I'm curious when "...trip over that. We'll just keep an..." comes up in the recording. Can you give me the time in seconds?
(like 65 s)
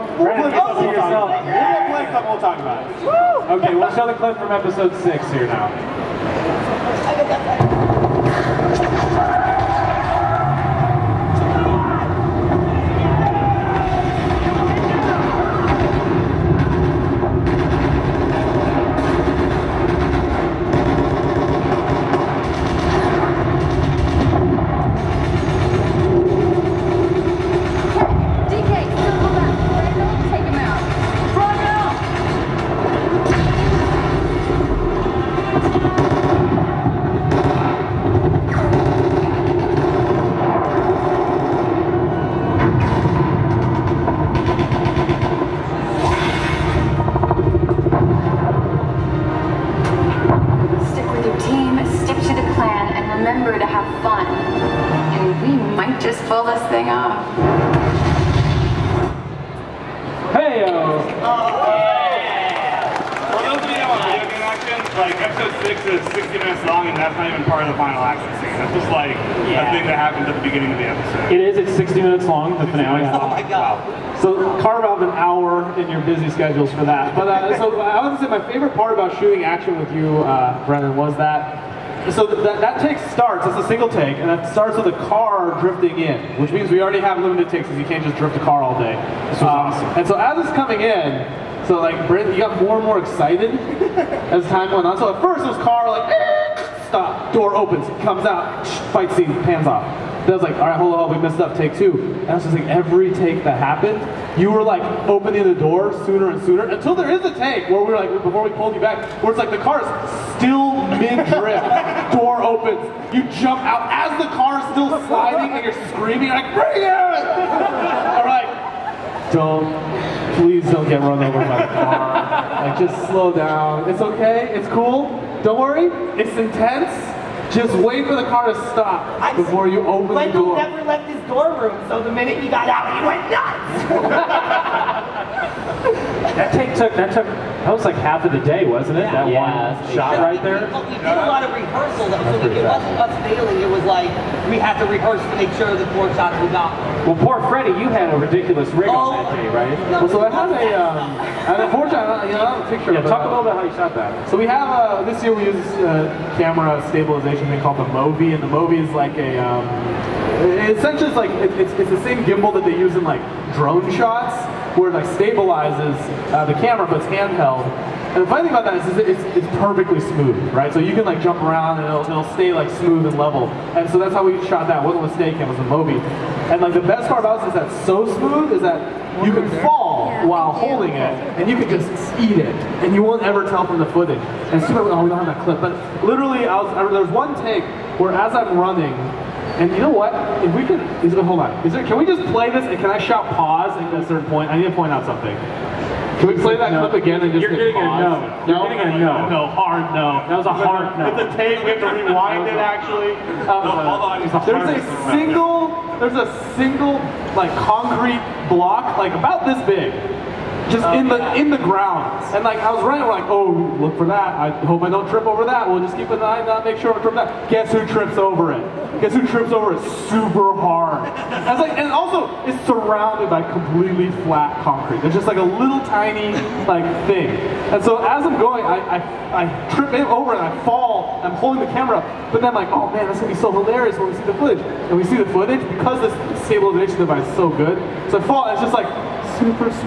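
215 s.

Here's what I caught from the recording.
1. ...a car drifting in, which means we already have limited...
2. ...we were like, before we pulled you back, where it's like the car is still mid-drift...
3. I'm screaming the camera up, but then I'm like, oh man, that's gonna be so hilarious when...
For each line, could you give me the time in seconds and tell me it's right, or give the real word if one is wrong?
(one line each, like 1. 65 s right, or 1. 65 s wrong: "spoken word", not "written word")
1. 84 s right
2. 107 s right
3. 231 s wrong: "holding", not "screaming".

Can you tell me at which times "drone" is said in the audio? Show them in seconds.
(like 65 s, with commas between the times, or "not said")
163 s.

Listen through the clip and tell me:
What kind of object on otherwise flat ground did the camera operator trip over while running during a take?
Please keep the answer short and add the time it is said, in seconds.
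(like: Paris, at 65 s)
Concrete block, at 207 s.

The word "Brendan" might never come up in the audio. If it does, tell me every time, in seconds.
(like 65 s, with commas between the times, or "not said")
0 s, 80 s.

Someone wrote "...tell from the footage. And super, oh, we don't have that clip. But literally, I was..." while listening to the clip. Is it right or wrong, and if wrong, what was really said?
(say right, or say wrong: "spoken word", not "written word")
right.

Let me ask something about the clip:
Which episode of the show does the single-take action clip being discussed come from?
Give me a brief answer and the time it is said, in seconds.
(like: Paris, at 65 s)
6, at 4 s.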